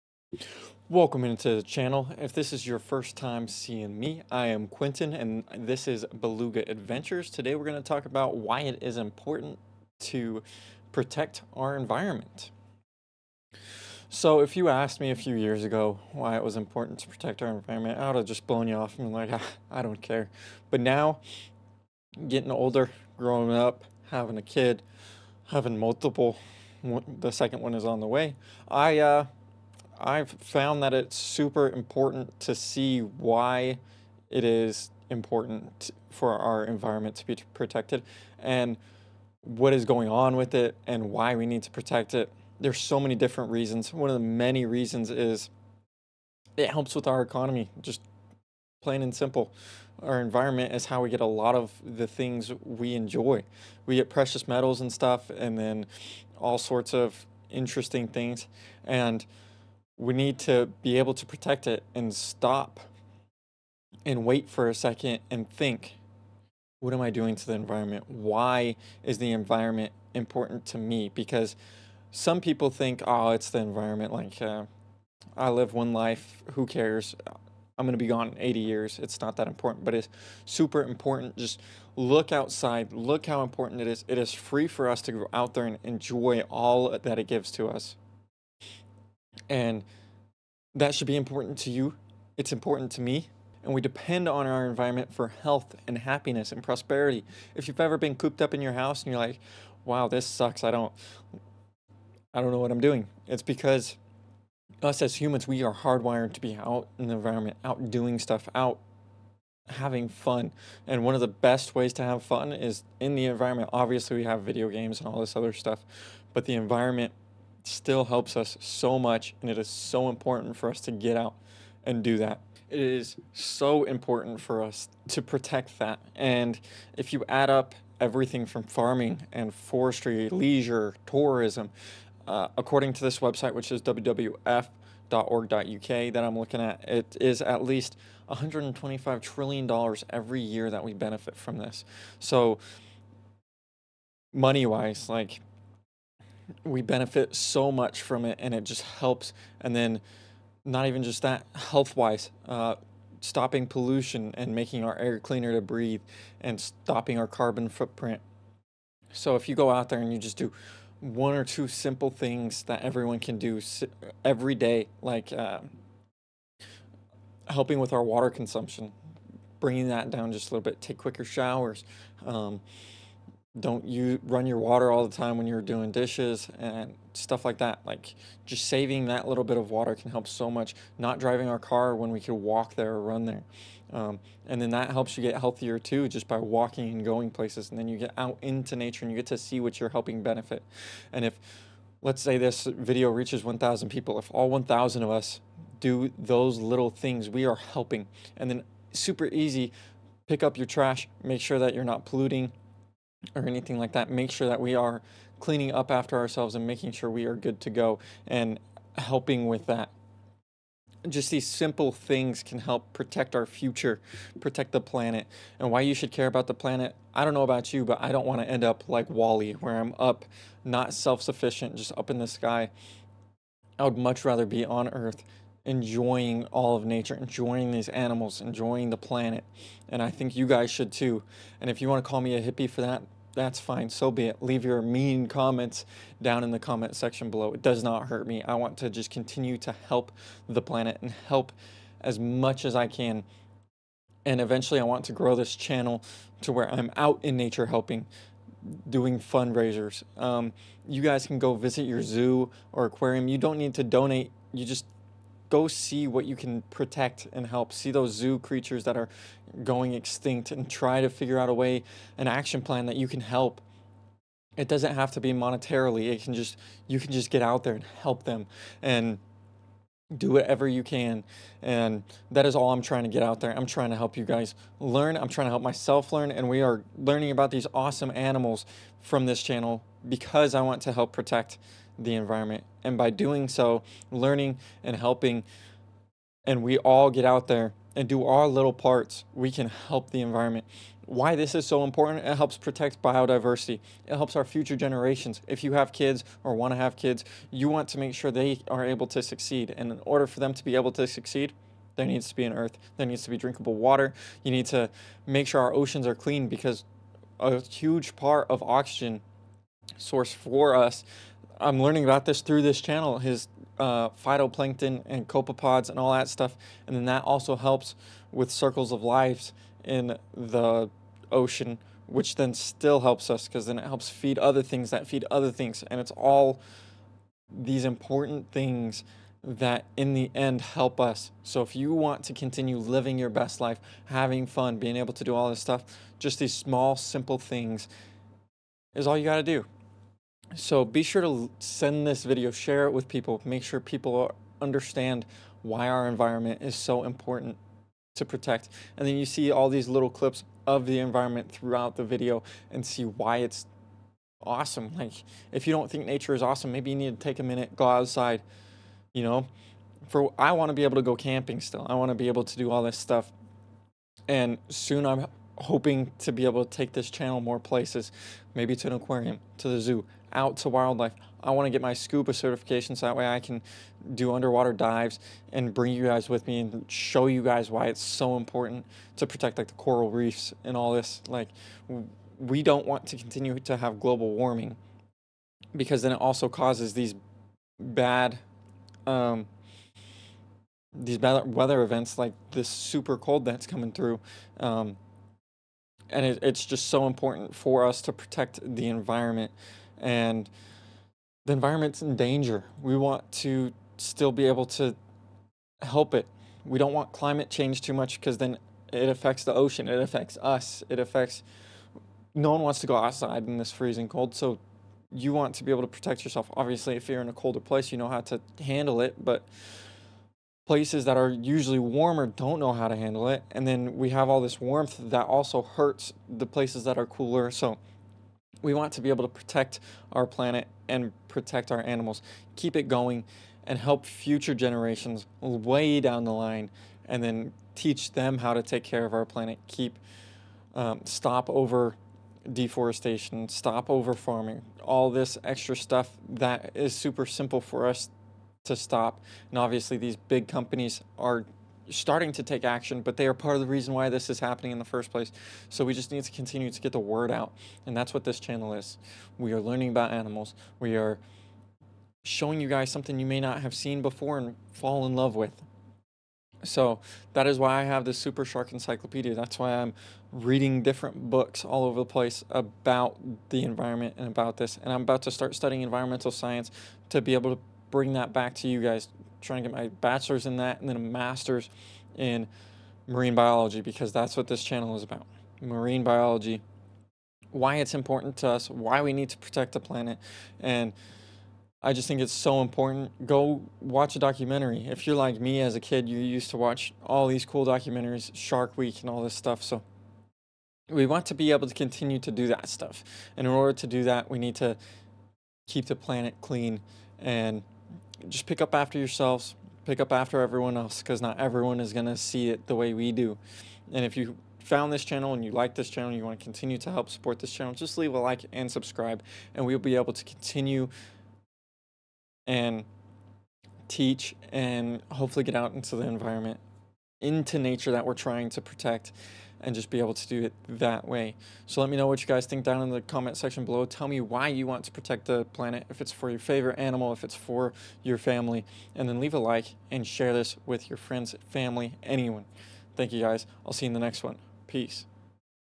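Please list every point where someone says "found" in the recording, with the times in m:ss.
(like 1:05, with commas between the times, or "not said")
0:30, 8:34.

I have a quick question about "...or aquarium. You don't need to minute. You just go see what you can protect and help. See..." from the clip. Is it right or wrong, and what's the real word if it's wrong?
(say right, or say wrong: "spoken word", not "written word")
wrong: "donate", not "minute".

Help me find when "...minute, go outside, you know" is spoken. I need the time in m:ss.
5:57.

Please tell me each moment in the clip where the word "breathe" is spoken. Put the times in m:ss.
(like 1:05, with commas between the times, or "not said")
2:35.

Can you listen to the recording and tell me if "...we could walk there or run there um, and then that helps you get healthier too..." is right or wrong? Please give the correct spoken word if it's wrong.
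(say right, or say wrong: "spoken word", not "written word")
right.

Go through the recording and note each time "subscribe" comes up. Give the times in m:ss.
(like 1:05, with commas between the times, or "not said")
8:38.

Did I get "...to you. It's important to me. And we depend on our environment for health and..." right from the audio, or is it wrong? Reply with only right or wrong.
right.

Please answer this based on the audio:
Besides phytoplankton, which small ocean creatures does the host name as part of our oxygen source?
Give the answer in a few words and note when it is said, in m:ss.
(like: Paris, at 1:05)
copepods, at 5:15.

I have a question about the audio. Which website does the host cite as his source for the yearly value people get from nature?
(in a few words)
wwf.org.uk.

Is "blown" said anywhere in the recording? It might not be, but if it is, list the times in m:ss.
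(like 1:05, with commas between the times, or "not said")
0:18.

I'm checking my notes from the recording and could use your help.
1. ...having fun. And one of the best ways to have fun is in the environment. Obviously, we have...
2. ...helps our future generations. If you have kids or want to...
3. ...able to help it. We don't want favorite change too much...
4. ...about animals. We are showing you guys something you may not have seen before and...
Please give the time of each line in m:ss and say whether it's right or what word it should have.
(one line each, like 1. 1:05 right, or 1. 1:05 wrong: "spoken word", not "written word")
1. 1:49 right
2. 4:54 right
3. 6:44 wrong: "climate", not "favorite"
4. 7:39 right.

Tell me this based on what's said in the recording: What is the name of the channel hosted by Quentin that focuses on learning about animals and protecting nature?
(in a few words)
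Beluga Adventures.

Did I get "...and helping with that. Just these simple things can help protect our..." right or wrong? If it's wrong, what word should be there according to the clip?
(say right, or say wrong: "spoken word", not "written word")
right.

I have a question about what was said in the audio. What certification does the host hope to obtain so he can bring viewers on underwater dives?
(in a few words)
scuba certification.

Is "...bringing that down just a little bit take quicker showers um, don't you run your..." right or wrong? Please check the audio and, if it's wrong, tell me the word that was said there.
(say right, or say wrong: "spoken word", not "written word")
right.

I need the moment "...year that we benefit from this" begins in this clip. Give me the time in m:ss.
2:20.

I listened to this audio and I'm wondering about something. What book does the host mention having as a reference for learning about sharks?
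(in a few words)
Super Shark Encyclopedia.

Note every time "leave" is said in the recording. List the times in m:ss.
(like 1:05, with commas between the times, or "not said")
3:54, 8:37, 8:59.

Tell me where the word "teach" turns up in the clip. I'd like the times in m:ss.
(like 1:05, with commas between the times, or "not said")
7:17, 8:43.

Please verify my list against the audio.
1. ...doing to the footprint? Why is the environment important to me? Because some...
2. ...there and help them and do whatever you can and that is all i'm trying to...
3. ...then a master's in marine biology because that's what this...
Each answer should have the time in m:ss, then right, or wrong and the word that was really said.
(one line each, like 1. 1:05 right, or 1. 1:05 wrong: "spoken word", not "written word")
1. 1:07 wrong: "environment", not "footprint"
2. 4:27 right
3. 8:00 right.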